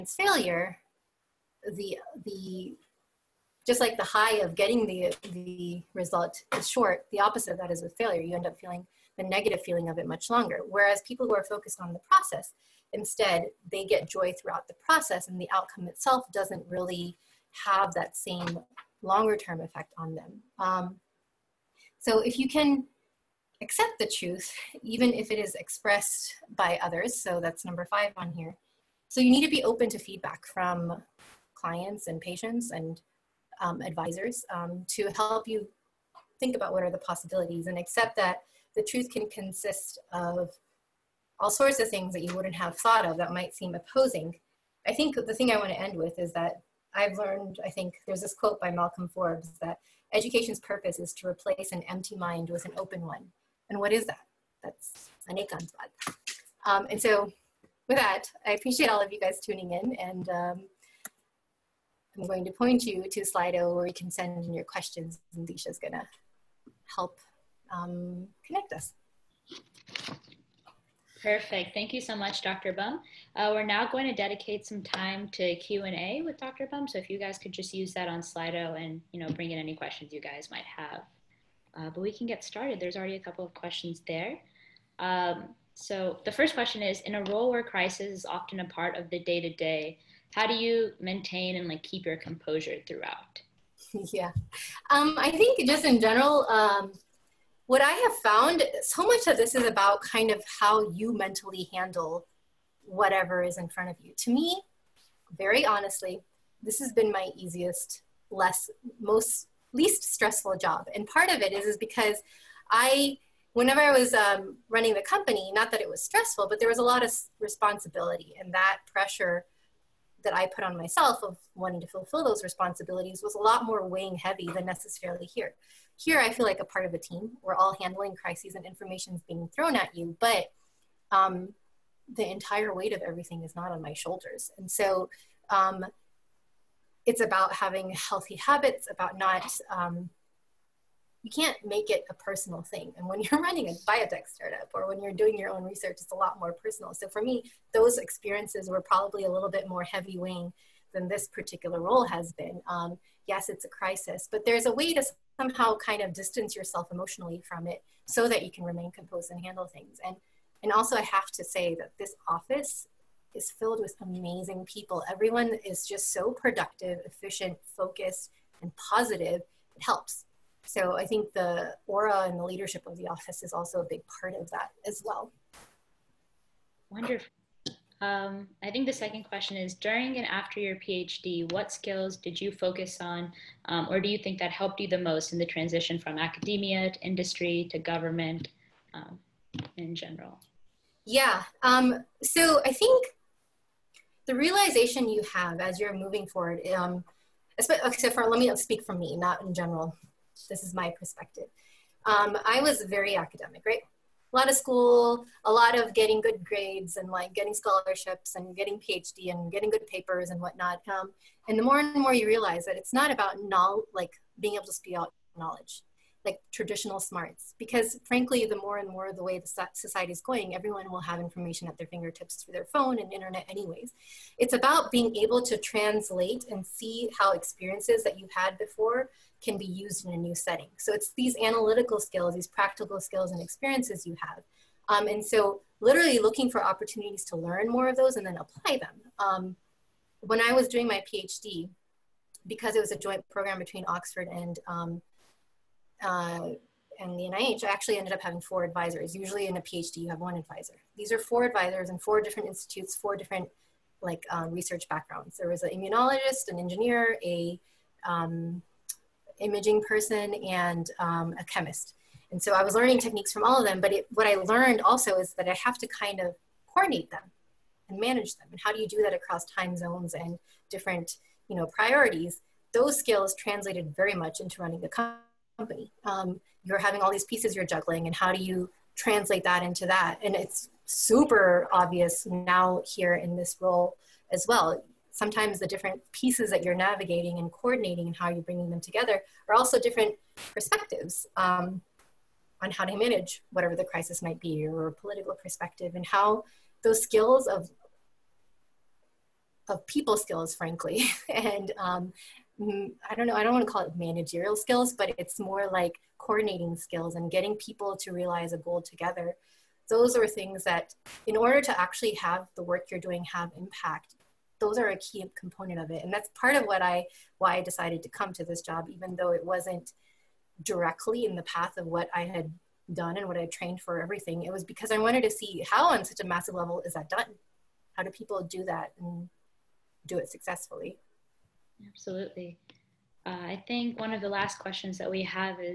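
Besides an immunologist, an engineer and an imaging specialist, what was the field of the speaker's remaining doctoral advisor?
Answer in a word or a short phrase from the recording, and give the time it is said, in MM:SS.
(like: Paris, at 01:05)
chemist, at 04:21.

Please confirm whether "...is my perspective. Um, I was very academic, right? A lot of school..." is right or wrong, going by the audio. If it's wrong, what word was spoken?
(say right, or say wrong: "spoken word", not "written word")
right.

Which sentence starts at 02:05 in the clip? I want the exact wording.
Here, I feel like a part of a team.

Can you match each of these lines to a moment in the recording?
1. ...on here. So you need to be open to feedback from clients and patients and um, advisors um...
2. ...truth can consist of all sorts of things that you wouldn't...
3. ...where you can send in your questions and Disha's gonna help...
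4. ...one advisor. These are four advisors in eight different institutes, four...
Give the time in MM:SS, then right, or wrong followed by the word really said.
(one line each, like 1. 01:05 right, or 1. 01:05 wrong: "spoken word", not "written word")
1. 00:28 right
2. 00:38 right
3. 01:03 right
4. 04:10 wrong: "four", not "eight".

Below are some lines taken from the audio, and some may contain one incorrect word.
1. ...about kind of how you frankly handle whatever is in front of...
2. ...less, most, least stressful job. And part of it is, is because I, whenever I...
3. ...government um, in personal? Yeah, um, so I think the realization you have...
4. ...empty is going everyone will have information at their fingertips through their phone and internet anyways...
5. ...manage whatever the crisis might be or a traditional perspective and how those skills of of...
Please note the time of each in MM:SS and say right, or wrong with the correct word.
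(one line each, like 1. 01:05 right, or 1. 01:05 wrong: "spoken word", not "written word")
1. 01:39 wrong: "mentally", not "frankly"
2. 01:48 right
3. 03:07 wrong: "general", not "personal"
4. 03:39 wrong: "society", not "empty"
5. 04:52 wrong: "political", not "traditional".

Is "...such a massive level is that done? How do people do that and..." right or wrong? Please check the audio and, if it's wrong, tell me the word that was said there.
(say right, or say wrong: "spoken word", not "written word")
right.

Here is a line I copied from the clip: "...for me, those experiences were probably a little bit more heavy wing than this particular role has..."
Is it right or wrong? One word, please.
right.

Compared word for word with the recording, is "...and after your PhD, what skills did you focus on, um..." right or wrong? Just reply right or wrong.
right.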